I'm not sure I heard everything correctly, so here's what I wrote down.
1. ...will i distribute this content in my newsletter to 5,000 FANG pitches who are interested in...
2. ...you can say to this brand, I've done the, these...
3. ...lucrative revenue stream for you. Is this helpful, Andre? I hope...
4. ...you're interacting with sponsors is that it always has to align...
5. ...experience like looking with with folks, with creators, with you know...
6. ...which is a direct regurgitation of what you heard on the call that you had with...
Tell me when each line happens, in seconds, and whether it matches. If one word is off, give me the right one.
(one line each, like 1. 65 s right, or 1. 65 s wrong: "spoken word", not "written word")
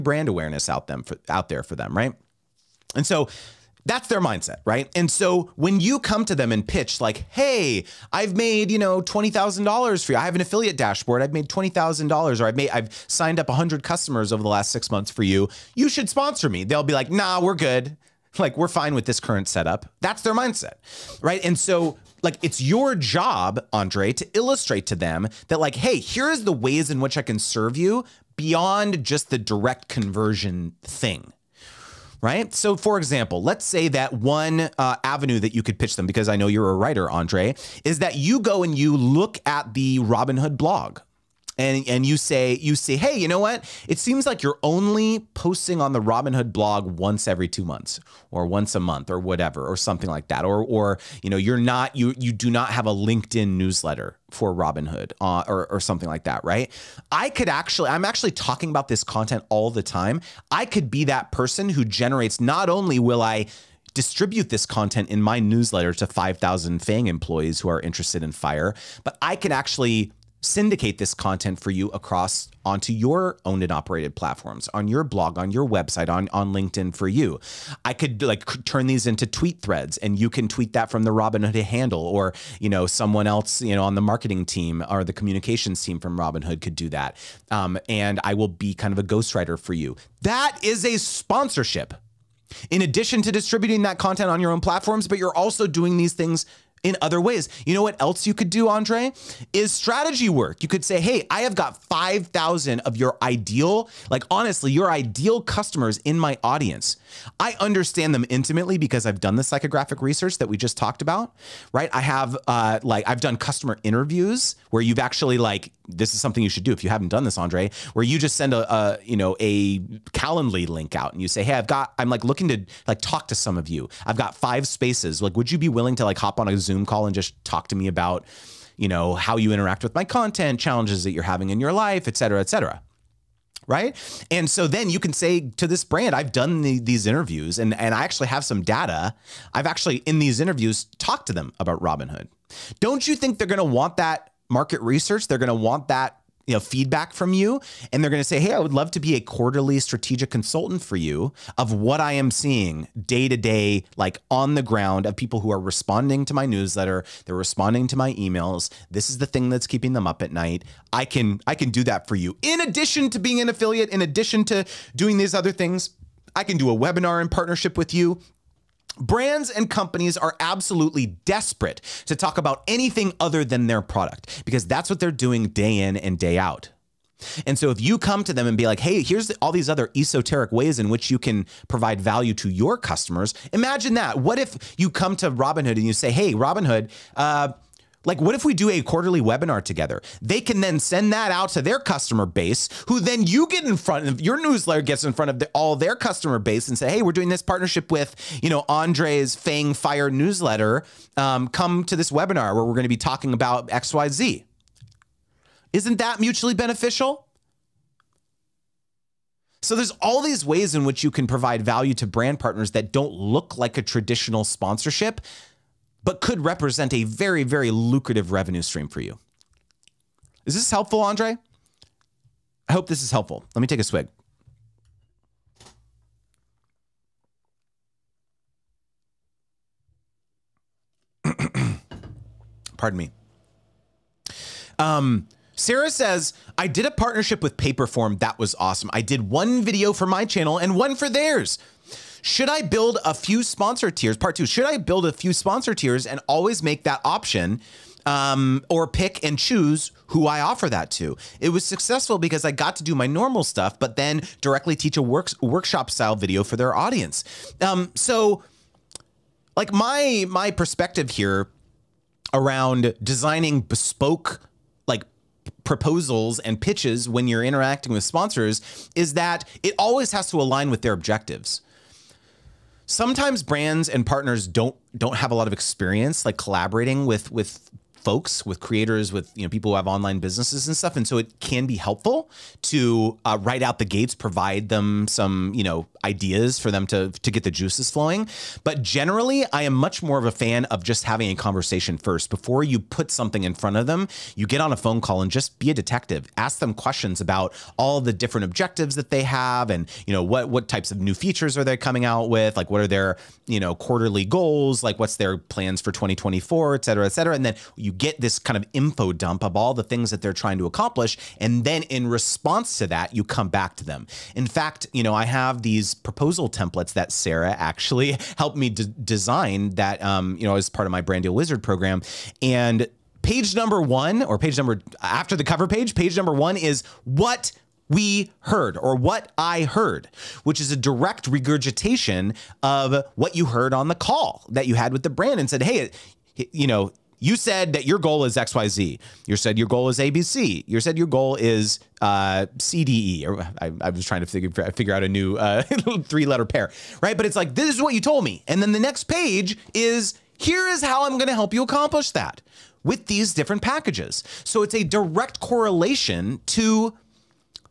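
1. 62 s wrong: "employees", not "pitches"
2. 134 s right
3. 217 s right
4. 267 s right
5. 275 s wrong: "collaborating", not "looking"
6. 330 s right.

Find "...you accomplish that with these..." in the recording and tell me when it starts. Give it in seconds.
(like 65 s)
351 s.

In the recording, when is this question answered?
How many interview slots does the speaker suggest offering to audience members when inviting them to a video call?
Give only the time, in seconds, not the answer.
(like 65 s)
124 s.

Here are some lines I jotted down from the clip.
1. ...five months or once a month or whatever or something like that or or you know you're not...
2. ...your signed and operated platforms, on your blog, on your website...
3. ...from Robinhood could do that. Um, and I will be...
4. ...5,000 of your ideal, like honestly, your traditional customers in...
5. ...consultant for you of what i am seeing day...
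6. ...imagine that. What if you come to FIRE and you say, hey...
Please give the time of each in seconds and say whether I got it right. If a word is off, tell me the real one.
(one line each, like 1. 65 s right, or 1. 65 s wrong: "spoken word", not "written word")
1. 47 s wrong: "two", not "five"
2. 72 s wrong: "owned", not "signed"
3. 85 s right
4. 101 s wrong: "ideal", not "traditional"
5. 150 s right
6. 183 s wrong: "Robinhood", not "FIRE".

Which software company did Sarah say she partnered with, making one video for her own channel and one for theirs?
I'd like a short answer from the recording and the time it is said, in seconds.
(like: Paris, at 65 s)
Paperform, at 237 s.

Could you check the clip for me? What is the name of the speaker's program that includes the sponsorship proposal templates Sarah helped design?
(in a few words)
Brand Deal Wizard.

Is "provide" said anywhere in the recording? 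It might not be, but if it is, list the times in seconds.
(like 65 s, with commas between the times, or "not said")
181 s, 211 s, 284 s.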